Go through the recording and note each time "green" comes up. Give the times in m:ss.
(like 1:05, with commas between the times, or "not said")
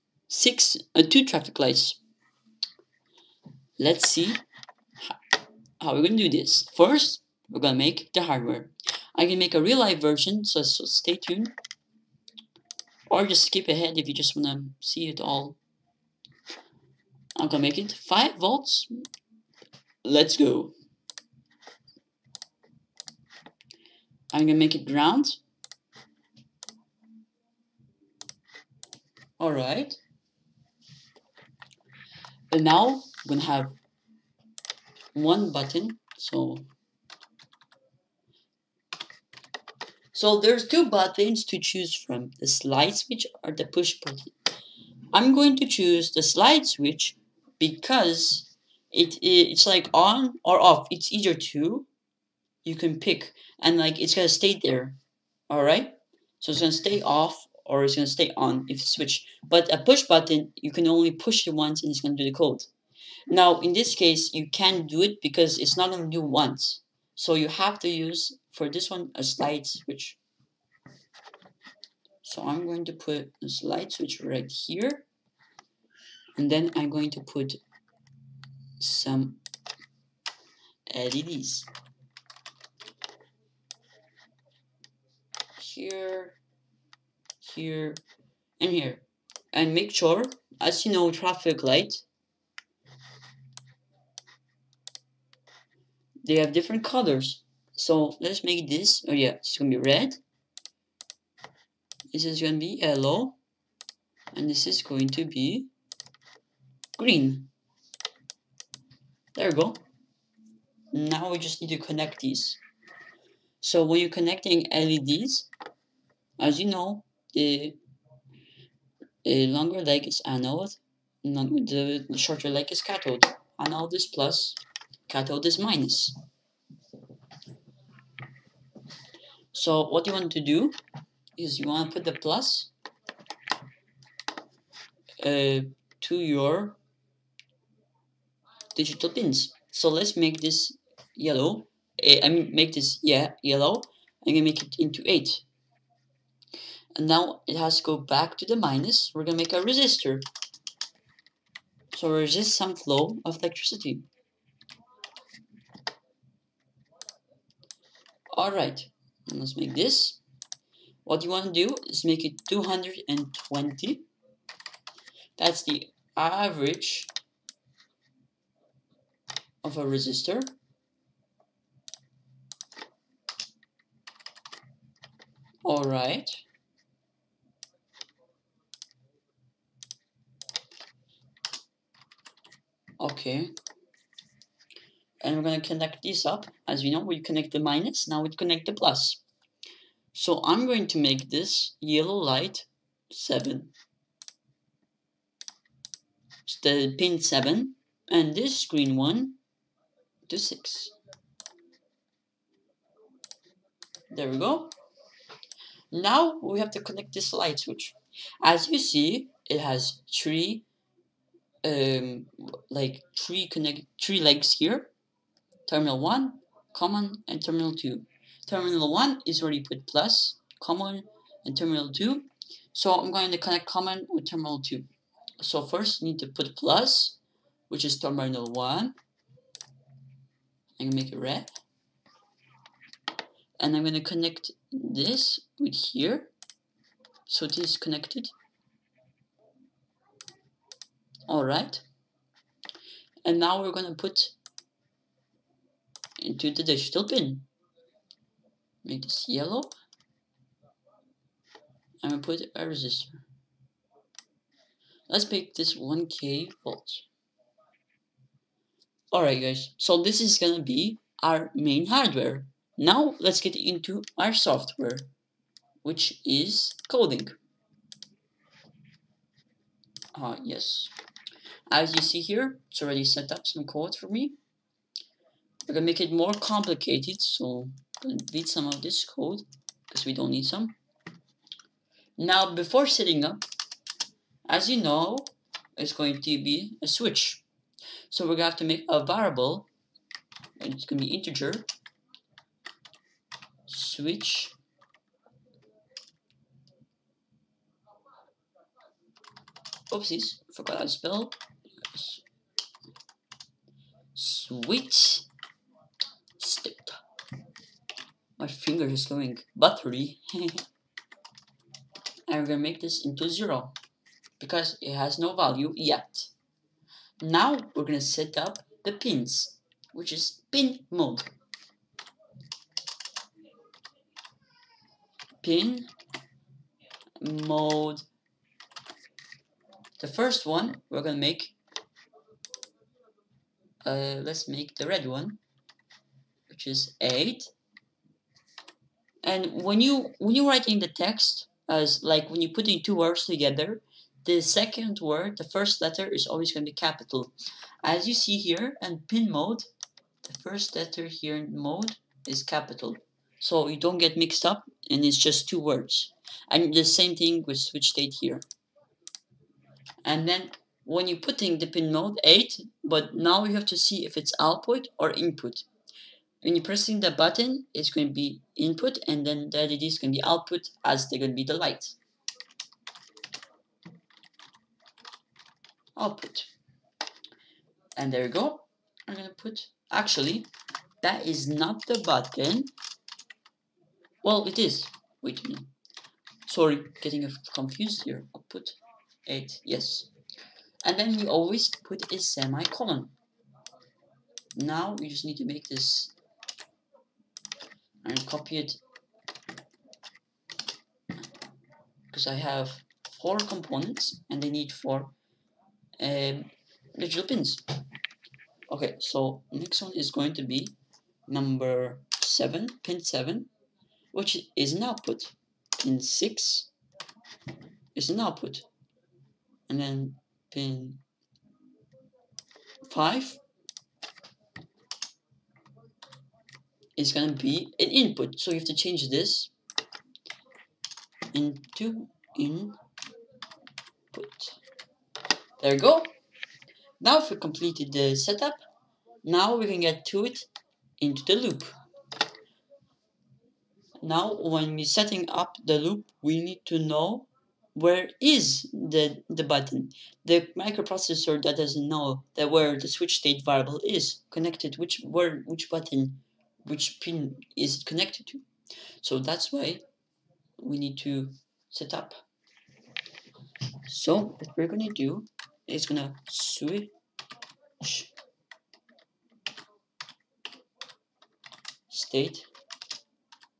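1:46, 3:18.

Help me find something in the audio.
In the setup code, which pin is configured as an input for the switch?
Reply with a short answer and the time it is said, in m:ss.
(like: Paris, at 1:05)
5, at 7:00.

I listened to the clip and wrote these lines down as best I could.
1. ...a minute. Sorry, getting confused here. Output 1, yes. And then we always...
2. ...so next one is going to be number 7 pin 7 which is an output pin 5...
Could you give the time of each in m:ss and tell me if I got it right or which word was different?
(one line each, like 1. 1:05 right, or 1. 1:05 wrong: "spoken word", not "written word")
1. 6:25 wrong: "8", not "1"
2. 6:48 wrong: "6", not "5".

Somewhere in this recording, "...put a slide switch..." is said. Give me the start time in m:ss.
1:12.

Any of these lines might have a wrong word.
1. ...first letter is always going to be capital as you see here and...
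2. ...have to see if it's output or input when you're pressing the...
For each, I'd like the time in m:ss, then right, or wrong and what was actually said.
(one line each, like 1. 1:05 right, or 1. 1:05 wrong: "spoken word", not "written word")
1. 5:45 right
2. 6:03 right.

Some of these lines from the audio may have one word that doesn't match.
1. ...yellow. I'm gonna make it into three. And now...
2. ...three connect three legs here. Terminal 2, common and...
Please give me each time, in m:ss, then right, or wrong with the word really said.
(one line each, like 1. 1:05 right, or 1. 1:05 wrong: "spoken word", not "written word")
1. 2:23 wrong: "eight", not "three"
2. 3:33 wrong: "1", not "2".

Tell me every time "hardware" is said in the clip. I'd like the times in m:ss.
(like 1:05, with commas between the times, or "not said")
0:08, 4:21.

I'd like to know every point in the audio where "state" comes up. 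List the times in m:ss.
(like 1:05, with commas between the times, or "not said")
5:57, 7:33, 7:51.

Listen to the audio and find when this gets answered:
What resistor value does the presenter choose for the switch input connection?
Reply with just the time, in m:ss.
4:15.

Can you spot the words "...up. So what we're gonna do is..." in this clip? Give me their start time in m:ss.
7:41.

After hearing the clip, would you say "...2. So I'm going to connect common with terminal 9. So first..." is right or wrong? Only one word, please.
wrong.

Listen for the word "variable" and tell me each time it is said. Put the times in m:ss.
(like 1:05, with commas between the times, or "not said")
4:49, 7:33.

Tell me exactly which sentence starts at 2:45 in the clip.
That's the average of a resistor.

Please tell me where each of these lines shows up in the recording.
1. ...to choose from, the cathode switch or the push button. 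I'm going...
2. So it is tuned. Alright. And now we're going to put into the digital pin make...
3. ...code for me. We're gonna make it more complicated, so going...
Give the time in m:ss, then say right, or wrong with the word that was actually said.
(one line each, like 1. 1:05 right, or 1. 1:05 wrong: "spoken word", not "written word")
1. 0:41 wrong: "slide", not "cathode"
2. 3:57 wrong: "connected", not "tuned"
3. 4:33 right.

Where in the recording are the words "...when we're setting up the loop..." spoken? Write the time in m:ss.
7:24.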